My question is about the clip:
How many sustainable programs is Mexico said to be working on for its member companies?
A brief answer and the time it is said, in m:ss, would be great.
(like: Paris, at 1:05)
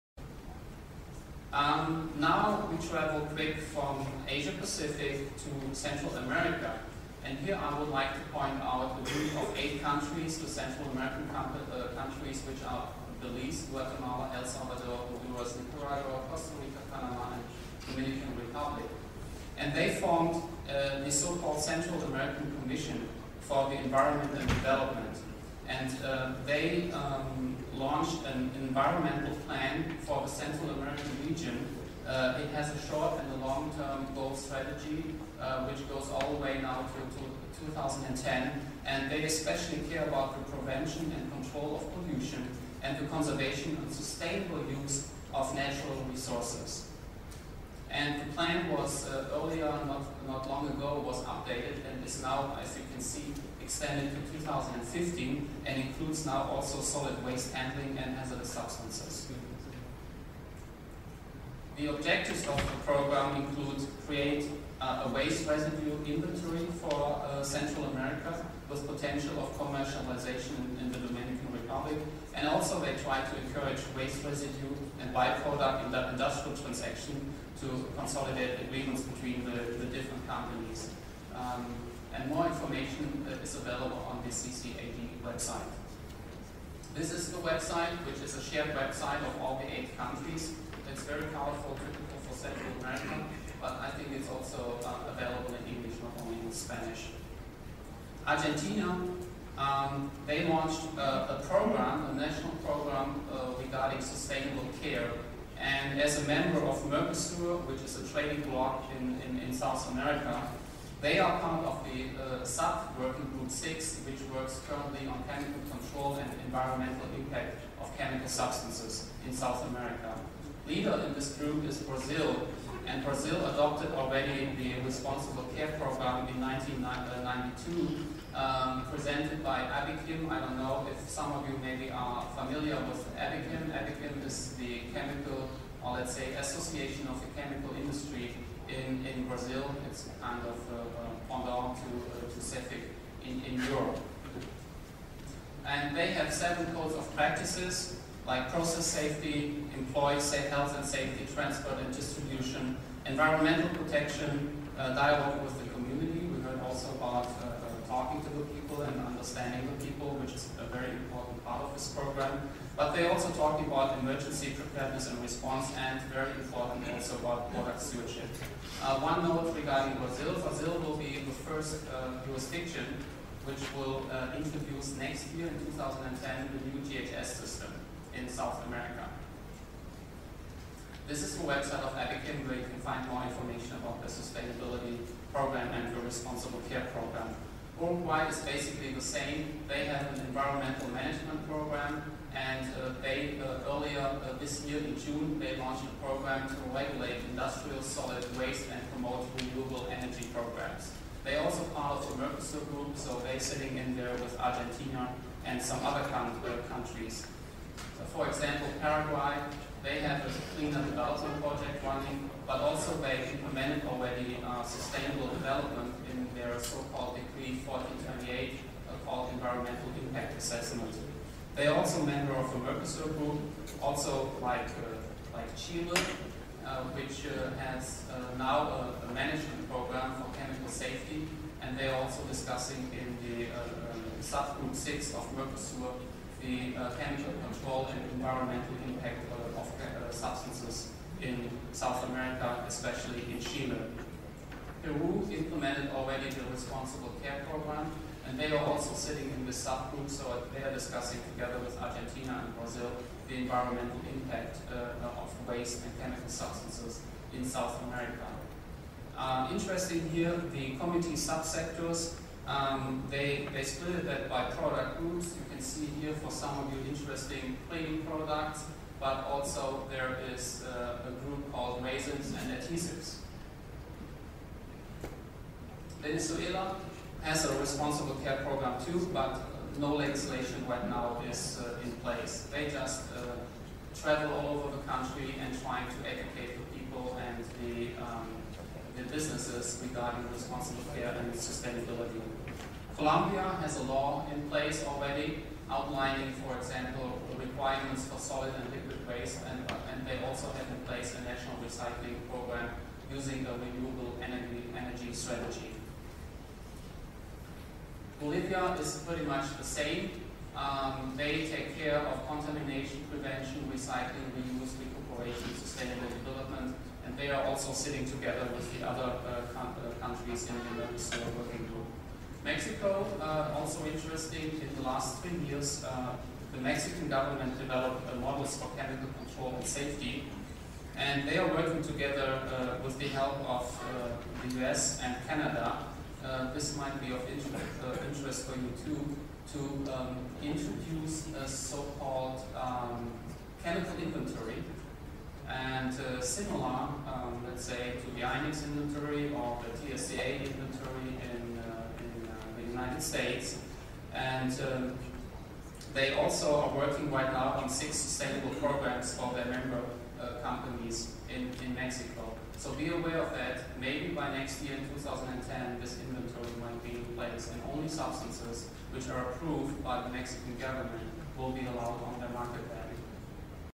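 6, at 5:57.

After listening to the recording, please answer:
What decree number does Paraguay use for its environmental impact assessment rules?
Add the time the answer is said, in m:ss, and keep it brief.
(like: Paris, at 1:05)
1428, at 3:37.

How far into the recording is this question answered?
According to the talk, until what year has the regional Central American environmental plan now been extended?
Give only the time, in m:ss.
0:54.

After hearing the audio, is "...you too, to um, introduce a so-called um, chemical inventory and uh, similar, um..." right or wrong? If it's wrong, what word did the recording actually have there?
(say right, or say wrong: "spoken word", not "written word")
right.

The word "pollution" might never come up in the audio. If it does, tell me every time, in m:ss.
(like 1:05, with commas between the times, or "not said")
0:41.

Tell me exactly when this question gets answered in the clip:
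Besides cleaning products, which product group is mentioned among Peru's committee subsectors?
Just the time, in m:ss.
4:31.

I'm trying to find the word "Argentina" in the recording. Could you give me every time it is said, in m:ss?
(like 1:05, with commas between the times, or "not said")
1:38, 3:24, 4:11.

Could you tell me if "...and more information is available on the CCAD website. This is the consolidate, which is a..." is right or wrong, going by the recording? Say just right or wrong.
wrong.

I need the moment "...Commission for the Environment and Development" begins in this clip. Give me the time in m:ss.
0:22.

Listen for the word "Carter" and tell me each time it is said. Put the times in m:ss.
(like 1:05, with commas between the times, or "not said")
not said.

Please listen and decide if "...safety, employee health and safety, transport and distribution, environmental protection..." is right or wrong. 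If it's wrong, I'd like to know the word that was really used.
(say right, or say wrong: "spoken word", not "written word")
right.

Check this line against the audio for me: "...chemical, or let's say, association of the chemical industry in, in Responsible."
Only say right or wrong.
wrong.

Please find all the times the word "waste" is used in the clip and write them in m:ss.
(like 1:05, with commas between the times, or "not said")
0:57, 1:05, 1:13, 3:18, 4:15, 4:59.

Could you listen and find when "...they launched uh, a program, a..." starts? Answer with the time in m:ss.
1:40.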